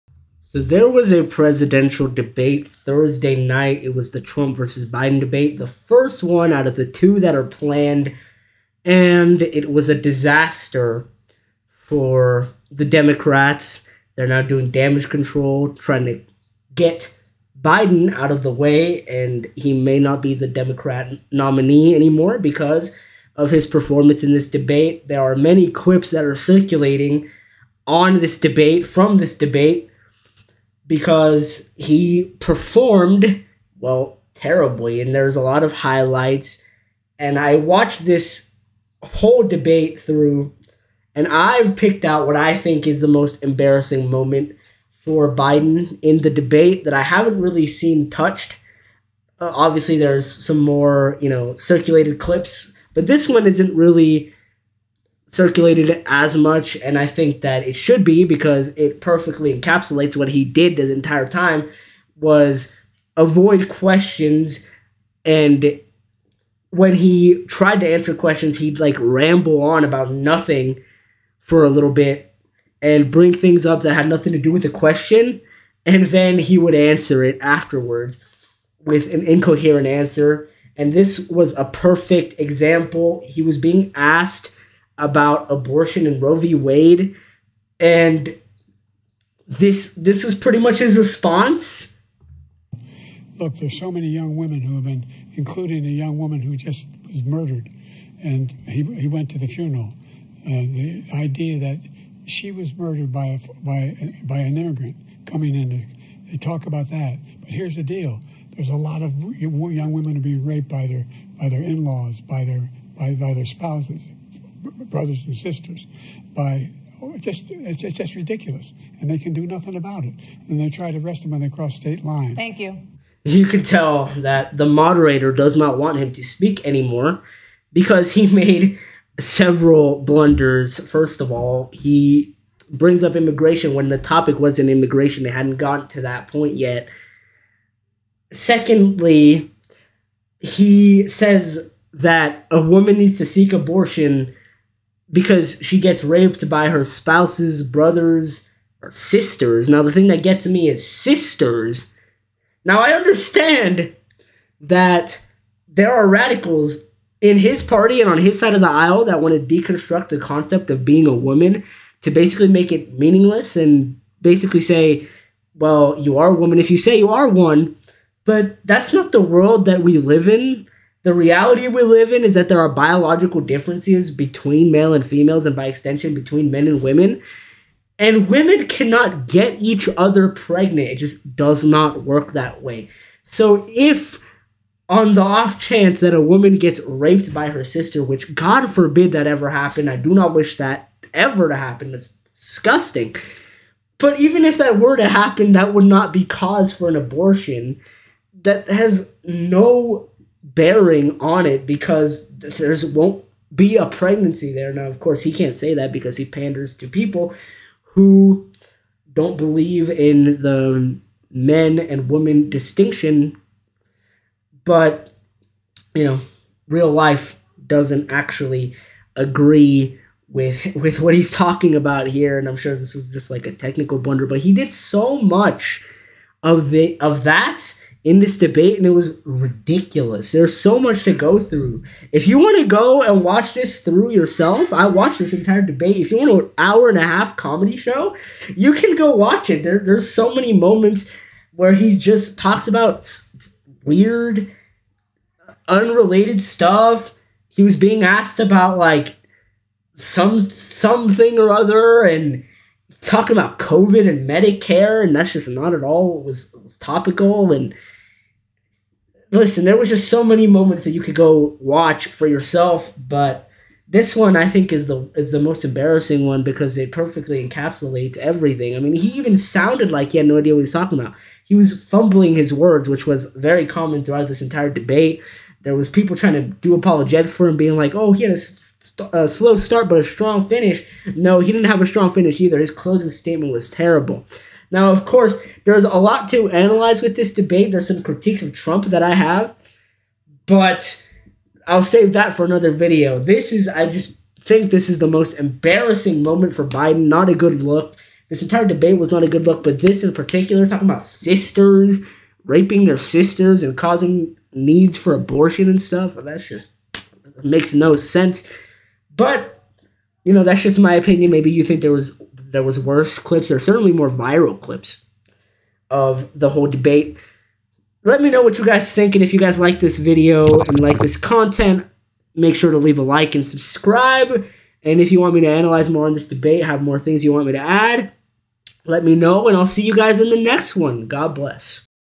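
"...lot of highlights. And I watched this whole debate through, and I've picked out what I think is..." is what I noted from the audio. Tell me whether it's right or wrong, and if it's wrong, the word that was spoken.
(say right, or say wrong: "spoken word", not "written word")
right.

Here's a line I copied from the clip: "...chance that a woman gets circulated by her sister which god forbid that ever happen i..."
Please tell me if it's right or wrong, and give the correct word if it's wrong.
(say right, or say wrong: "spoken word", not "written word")
wrong: "raped", not "circulated".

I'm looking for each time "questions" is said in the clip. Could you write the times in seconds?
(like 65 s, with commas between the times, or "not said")
63 s, 68 s, 74 s.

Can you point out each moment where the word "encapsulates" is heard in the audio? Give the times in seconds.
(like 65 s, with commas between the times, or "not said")
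59 s, 267 s.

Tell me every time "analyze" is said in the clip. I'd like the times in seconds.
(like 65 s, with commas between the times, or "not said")
286 s, 325 s.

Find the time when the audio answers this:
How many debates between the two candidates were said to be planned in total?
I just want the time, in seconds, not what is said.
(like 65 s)
6 s.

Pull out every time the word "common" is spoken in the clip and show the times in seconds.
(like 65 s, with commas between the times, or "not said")
273 s.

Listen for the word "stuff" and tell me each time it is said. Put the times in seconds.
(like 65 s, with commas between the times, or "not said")
246 s, 305 s.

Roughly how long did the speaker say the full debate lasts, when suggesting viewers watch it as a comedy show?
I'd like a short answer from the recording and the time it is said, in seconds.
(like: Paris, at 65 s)
An hour and a half, at 236 s.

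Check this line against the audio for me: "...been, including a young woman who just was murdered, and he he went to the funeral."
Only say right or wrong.
right.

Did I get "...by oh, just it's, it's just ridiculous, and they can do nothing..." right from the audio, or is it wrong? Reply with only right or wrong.
right.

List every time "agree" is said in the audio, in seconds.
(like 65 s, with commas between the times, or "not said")
219 s.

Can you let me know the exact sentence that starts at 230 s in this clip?
There's so much to go through.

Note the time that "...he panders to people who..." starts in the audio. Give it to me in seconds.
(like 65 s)
206 s.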